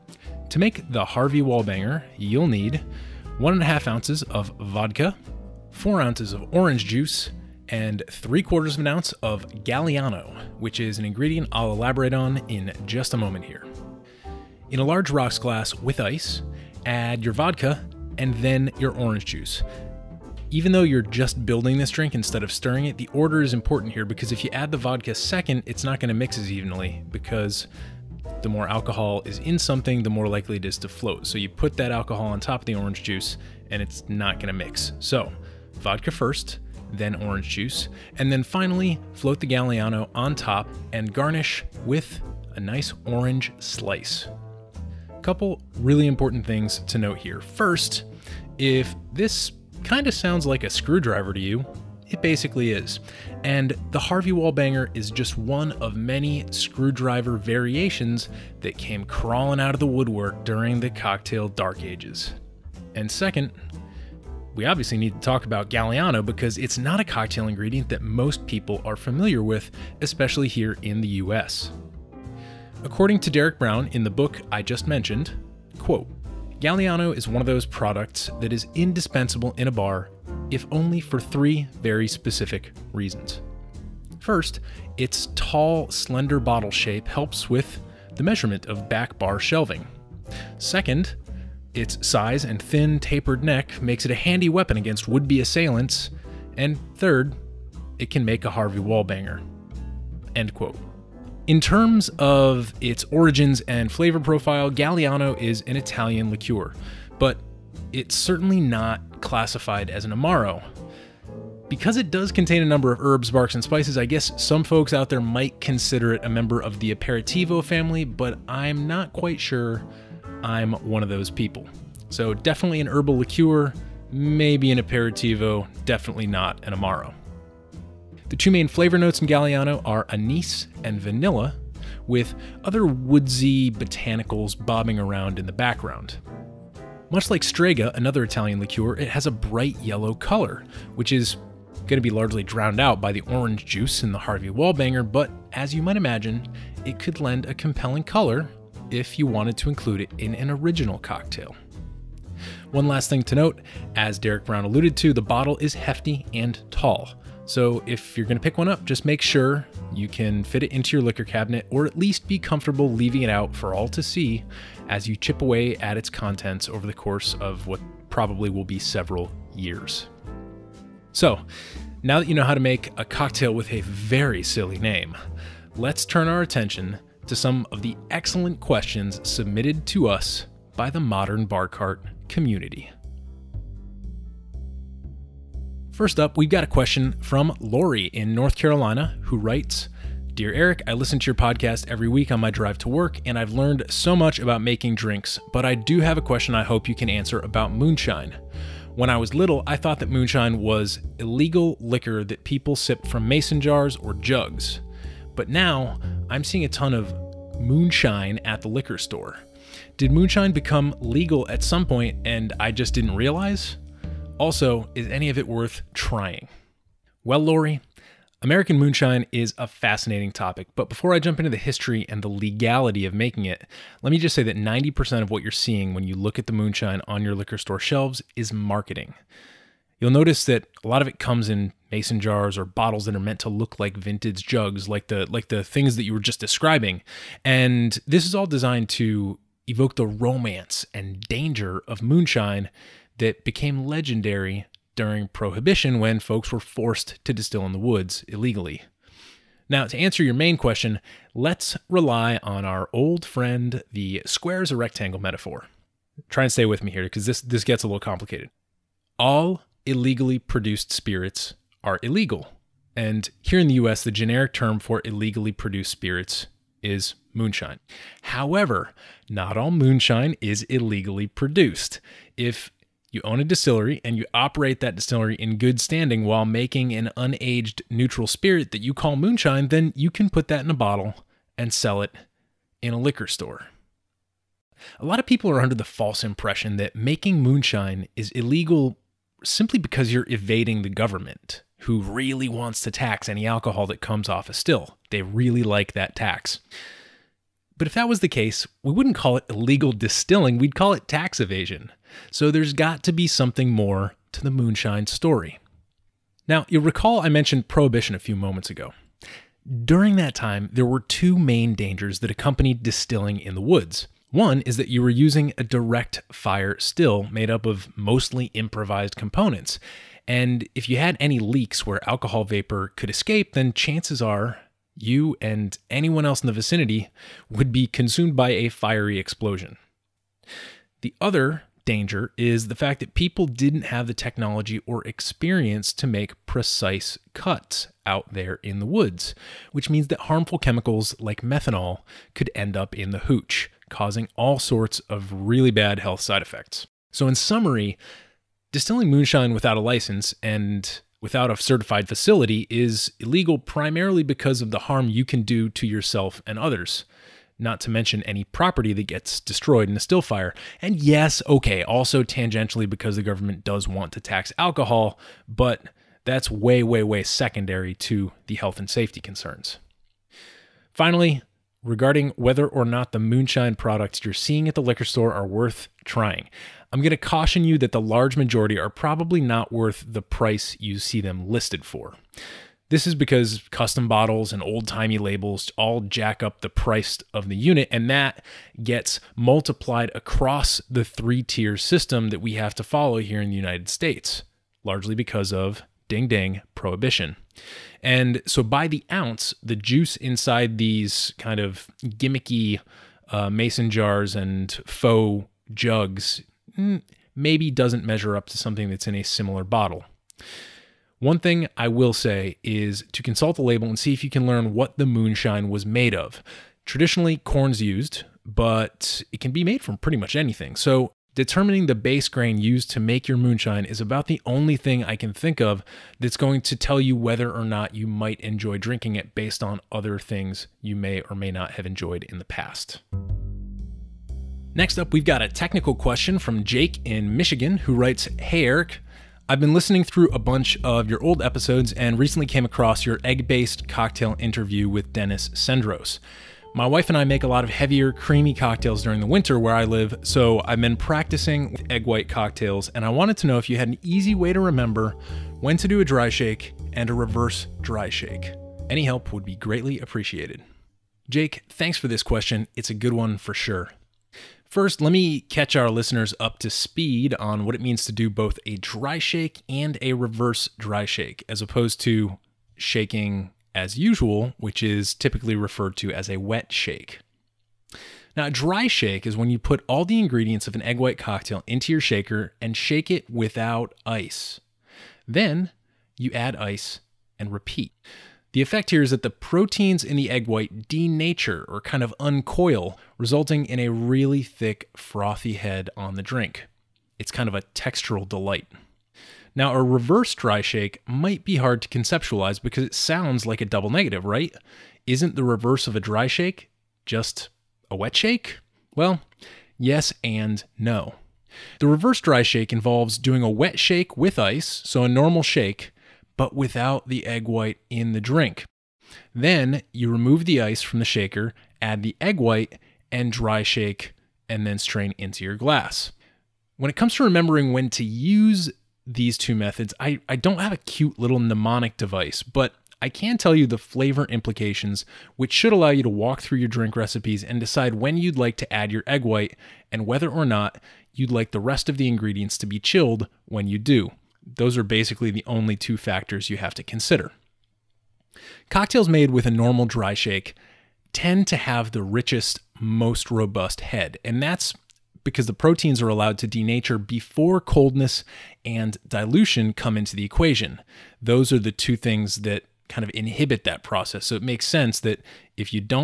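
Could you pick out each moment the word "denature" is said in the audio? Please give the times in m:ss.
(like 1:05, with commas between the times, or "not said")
8:10, 9:16.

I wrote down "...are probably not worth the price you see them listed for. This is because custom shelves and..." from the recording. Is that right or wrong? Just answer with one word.
wrong.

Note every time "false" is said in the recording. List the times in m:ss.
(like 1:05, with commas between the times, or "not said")
4:45.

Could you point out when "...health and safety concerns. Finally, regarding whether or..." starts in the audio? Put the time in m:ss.
6:08.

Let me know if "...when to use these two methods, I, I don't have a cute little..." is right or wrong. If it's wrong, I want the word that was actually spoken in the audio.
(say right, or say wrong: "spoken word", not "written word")
right.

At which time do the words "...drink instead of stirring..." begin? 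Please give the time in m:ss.
0:21.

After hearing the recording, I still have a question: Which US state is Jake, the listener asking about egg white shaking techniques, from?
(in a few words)
Michigan.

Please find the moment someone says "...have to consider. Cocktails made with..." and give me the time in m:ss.
9:06.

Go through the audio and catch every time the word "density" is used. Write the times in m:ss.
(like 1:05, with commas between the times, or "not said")
not said.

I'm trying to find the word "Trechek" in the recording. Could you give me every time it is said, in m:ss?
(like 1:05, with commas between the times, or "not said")
not said.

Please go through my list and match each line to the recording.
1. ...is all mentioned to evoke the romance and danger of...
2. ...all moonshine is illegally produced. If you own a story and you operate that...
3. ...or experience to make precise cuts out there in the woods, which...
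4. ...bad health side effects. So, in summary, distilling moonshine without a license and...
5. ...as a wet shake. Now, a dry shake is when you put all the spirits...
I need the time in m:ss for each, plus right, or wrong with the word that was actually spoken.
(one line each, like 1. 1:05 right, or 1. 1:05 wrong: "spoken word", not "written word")
1. 3:58 wrong: "designed", not "mentioned"
2. 4:29 wrong: "distillery", not "story"
3. 5:34 right
4. 5:45 right
5. 7:56 wrong: "ingredients", not "spirits".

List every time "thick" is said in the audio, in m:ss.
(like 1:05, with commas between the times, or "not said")
8:14.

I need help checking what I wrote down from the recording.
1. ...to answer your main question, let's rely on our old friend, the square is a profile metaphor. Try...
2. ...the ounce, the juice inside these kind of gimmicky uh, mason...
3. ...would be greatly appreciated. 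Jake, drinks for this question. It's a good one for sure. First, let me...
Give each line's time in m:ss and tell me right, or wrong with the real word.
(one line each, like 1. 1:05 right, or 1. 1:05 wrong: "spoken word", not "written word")
1. 4:09 wrong: "rectangle", not "profile"
2. 6:38 right
3. 7:39 wrong: "thanks", not "drinks".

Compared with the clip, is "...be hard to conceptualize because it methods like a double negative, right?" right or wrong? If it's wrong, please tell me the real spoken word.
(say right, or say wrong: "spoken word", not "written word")
wrong: "sounds", not "methods".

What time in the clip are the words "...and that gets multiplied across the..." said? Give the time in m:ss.
6:27.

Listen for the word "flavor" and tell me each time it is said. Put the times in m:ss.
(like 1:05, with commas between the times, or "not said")
1:43, 2:08, 8:53.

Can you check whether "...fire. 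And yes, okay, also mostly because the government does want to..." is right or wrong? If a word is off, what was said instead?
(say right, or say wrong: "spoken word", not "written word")
wrong: "tangentially", not "mostly".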